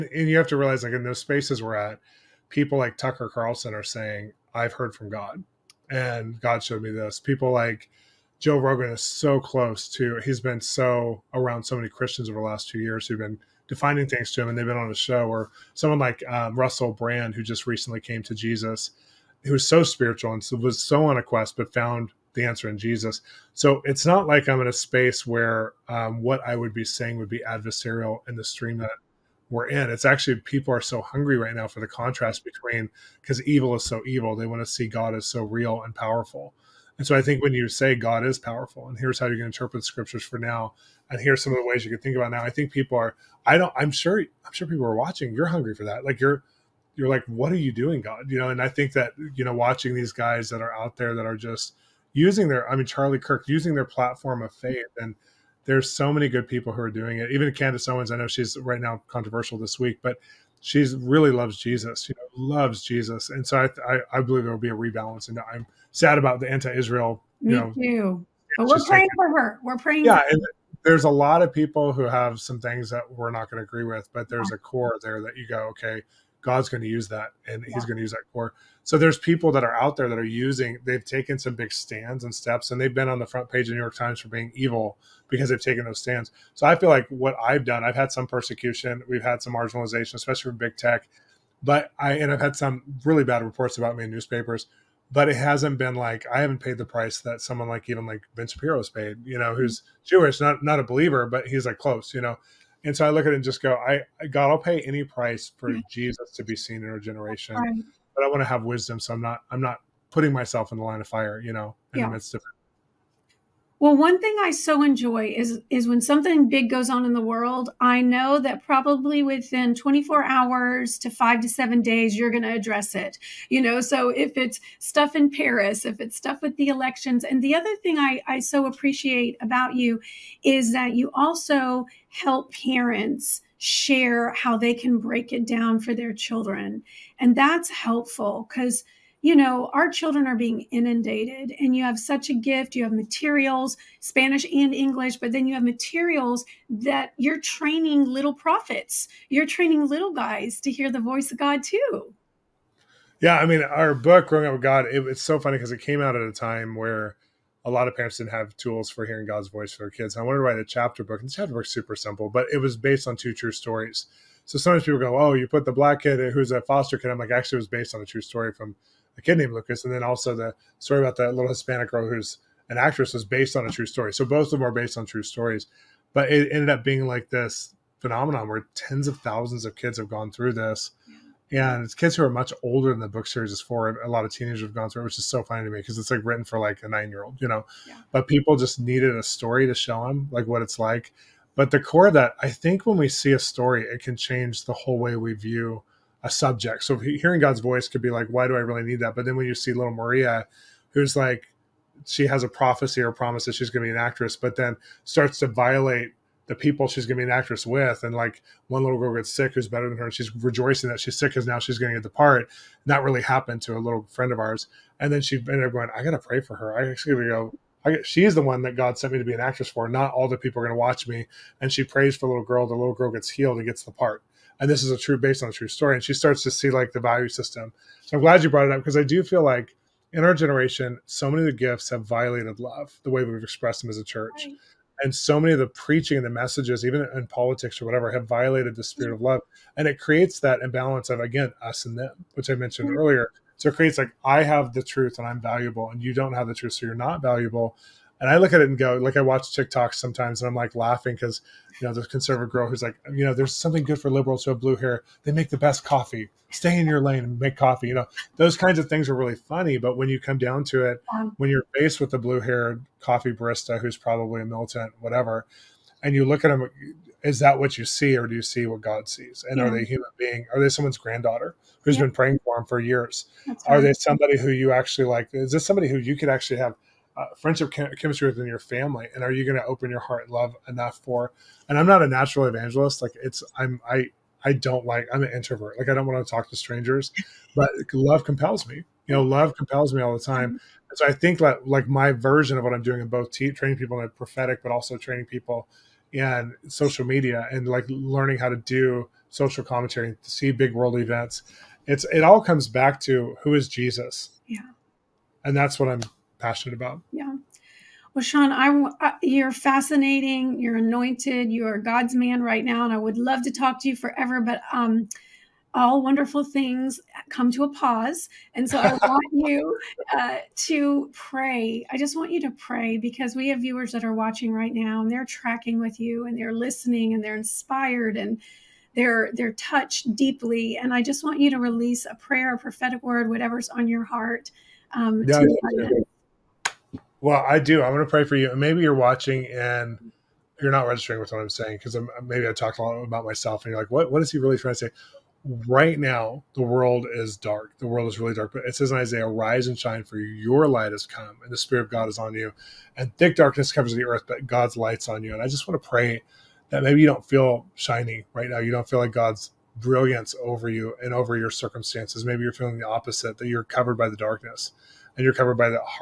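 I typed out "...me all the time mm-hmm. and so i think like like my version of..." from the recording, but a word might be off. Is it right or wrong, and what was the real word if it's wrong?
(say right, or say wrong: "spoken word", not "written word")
right.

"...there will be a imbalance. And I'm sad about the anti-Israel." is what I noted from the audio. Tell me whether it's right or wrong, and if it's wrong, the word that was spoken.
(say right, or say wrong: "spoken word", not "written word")
wrong: "rebalance", not "imbalance".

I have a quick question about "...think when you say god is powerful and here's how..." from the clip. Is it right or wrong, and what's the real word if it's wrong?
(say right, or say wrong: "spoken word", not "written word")
right.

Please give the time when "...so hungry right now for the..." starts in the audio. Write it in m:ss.
0:30.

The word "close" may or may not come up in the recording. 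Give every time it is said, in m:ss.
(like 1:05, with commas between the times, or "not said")
0:09, 1:41.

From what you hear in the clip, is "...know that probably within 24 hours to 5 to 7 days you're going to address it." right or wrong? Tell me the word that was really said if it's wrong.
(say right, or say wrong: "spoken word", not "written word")
right.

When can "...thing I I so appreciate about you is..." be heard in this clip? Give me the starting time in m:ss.
2:07.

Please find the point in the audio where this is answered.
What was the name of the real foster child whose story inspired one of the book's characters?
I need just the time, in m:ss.
2:49.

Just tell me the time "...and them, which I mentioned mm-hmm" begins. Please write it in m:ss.
4:01.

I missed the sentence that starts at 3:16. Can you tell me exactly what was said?
So hearing God's voice could be like, why do I really need that?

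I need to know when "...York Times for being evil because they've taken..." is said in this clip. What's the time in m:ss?
1:23.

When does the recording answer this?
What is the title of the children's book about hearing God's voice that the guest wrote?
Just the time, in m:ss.
2:34.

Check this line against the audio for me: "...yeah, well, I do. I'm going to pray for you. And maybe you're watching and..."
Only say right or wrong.
right.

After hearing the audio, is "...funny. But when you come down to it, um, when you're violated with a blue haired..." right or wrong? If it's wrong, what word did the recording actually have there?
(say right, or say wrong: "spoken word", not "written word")
wrong: "faced", not "violated".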